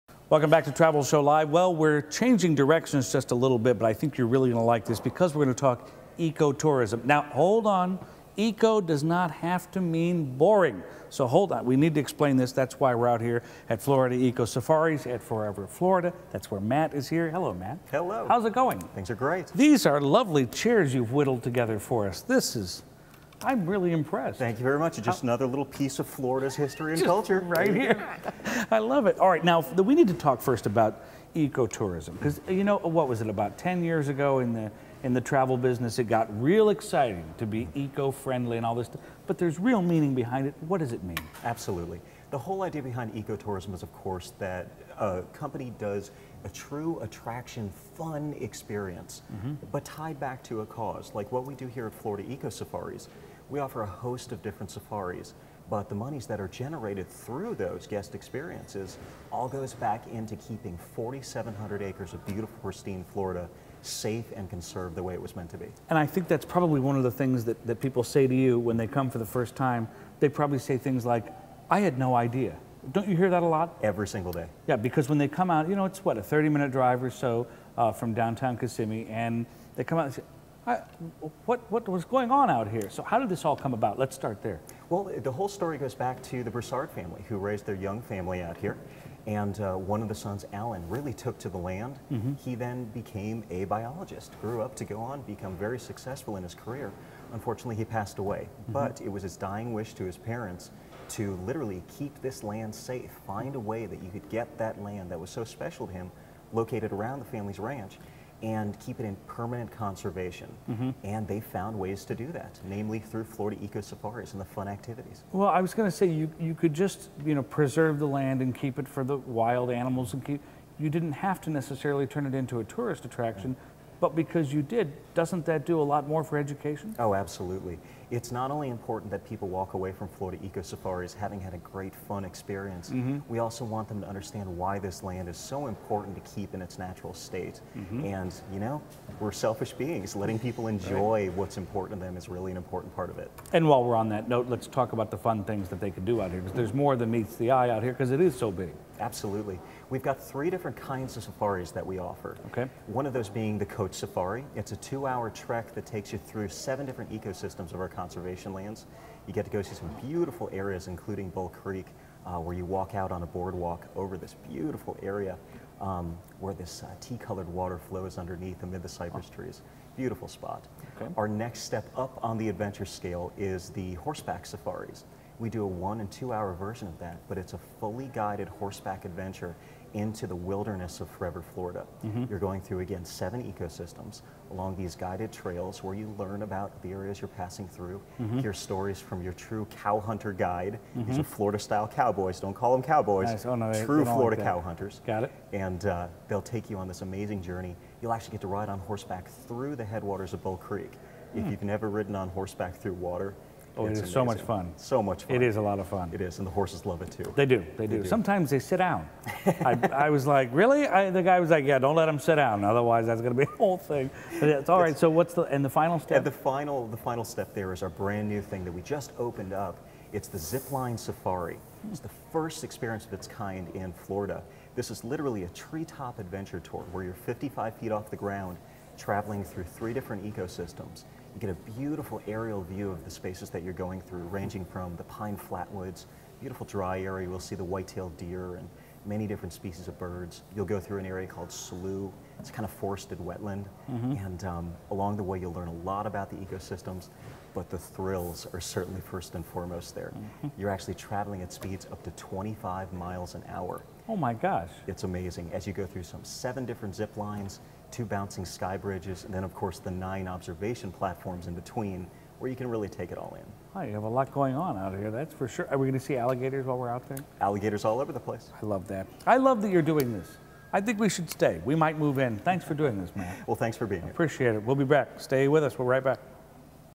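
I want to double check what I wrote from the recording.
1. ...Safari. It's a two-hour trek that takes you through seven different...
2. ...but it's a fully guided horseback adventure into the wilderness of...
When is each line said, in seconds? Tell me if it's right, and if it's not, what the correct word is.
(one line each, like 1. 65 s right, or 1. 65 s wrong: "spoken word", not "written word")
1. 153 s right
2. 177 s right.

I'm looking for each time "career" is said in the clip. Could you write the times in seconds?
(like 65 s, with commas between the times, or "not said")
96 s.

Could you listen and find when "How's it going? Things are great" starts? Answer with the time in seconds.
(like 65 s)
18 s.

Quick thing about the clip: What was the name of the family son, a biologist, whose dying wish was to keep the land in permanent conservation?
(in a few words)
Alan.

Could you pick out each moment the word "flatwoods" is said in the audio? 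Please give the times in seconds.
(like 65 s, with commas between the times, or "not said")
235 s.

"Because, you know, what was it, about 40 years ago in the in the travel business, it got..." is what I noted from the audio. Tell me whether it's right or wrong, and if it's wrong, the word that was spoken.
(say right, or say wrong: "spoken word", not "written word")
wrong: "10", not "40".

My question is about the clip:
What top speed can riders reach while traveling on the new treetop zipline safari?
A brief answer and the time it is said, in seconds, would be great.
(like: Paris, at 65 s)
25 miles an hour, at 252 s.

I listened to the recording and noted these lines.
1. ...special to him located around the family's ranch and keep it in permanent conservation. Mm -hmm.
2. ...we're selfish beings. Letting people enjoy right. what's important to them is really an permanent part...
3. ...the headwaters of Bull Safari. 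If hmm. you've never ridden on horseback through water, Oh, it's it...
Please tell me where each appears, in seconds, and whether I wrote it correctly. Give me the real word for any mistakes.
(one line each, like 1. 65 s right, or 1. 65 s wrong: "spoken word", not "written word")
1. 105 s right
2. 139 s wrong: "important", not "permanent"
3. 199 s wrong: "Creek", not "Safari".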